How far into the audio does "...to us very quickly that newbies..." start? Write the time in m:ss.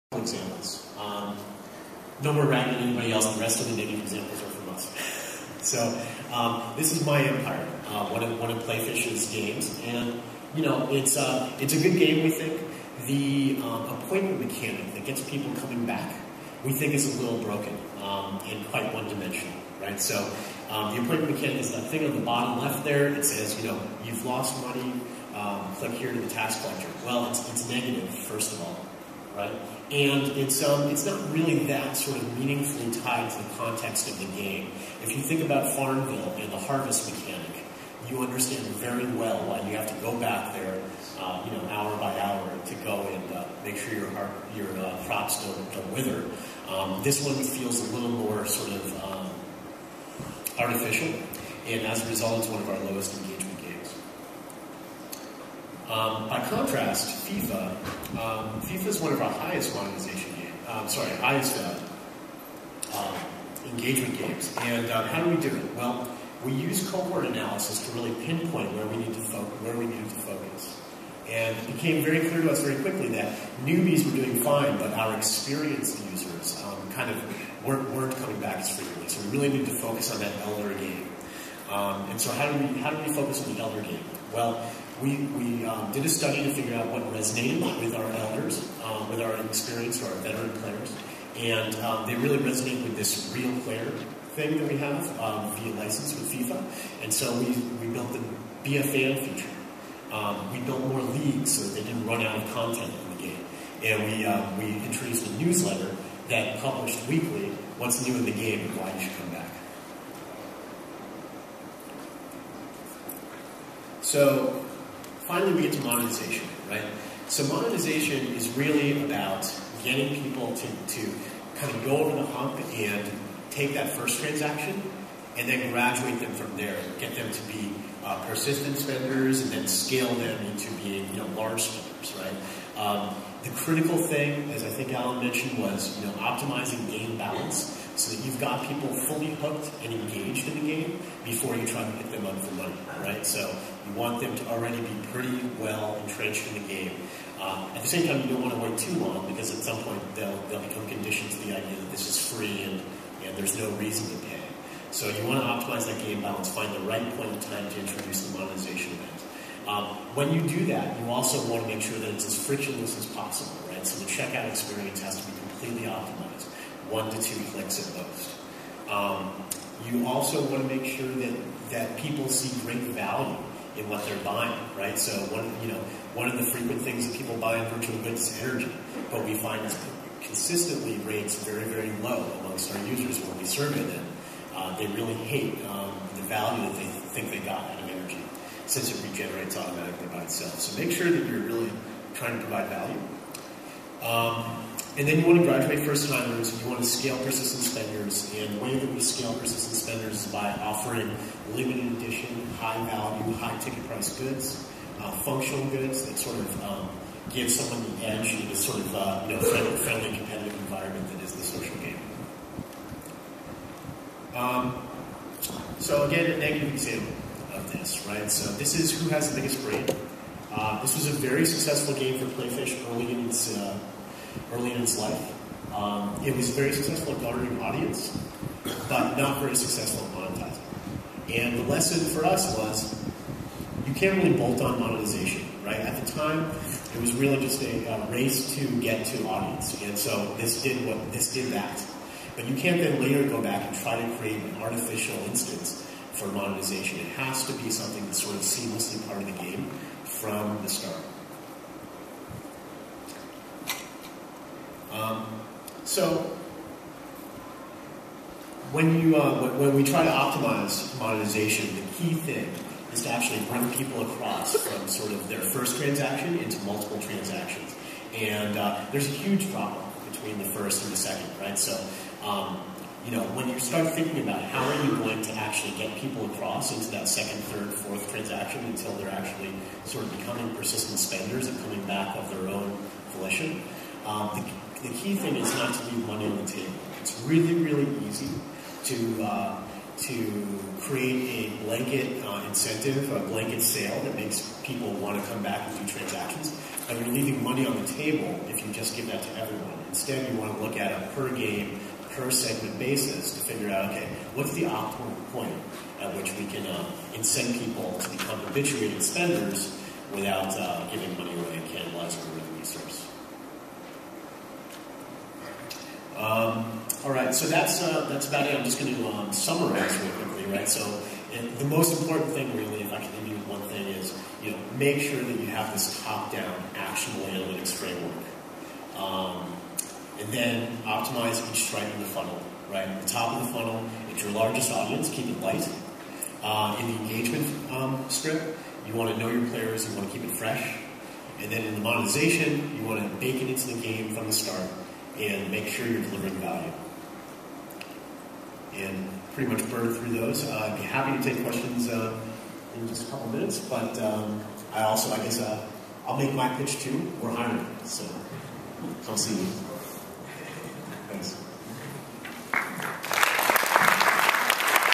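1:12.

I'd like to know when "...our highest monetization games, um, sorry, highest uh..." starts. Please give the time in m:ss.
0:59.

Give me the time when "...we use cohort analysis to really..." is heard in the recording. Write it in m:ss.
1:06.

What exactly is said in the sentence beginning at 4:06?
It has to be something that's sort of seamlessly part of the game from the start.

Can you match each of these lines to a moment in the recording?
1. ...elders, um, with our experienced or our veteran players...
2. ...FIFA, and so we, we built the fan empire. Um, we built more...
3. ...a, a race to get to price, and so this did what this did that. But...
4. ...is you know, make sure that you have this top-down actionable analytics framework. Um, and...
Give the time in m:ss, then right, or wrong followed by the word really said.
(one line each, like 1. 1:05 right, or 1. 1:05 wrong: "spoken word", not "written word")
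1. 1:28 right
2. 1:36 wrong: "feature", not "empire"
3. 3:57 wrong: "audience", not "price"
4. 5:23 right.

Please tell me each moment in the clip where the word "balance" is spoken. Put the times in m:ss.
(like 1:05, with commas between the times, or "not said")
2:17, 2:36.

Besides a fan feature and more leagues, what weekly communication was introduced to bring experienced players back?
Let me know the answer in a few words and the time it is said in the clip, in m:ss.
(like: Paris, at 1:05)
A newsletter, at 1:45.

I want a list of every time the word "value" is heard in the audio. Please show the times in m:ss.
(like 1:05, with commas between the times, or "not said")
2:52, 3:06, 3:12, 3:22, 5:46.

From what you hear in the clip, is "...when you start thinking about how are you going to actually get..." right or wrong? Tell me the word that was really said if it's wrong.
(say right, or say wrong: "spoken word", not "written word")
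right.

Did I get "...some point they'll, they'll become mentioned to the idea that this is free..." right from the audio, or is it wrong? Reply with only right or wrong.
wrong.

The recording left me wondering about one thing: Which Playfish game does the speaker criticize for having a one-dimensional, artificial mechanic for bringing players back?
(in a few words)
My Empire.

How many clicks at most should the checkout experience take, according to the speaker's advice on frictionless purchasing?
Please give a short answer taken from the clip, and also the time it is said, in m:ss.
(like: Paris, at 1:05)
1 to 2 clicks, at 2:46.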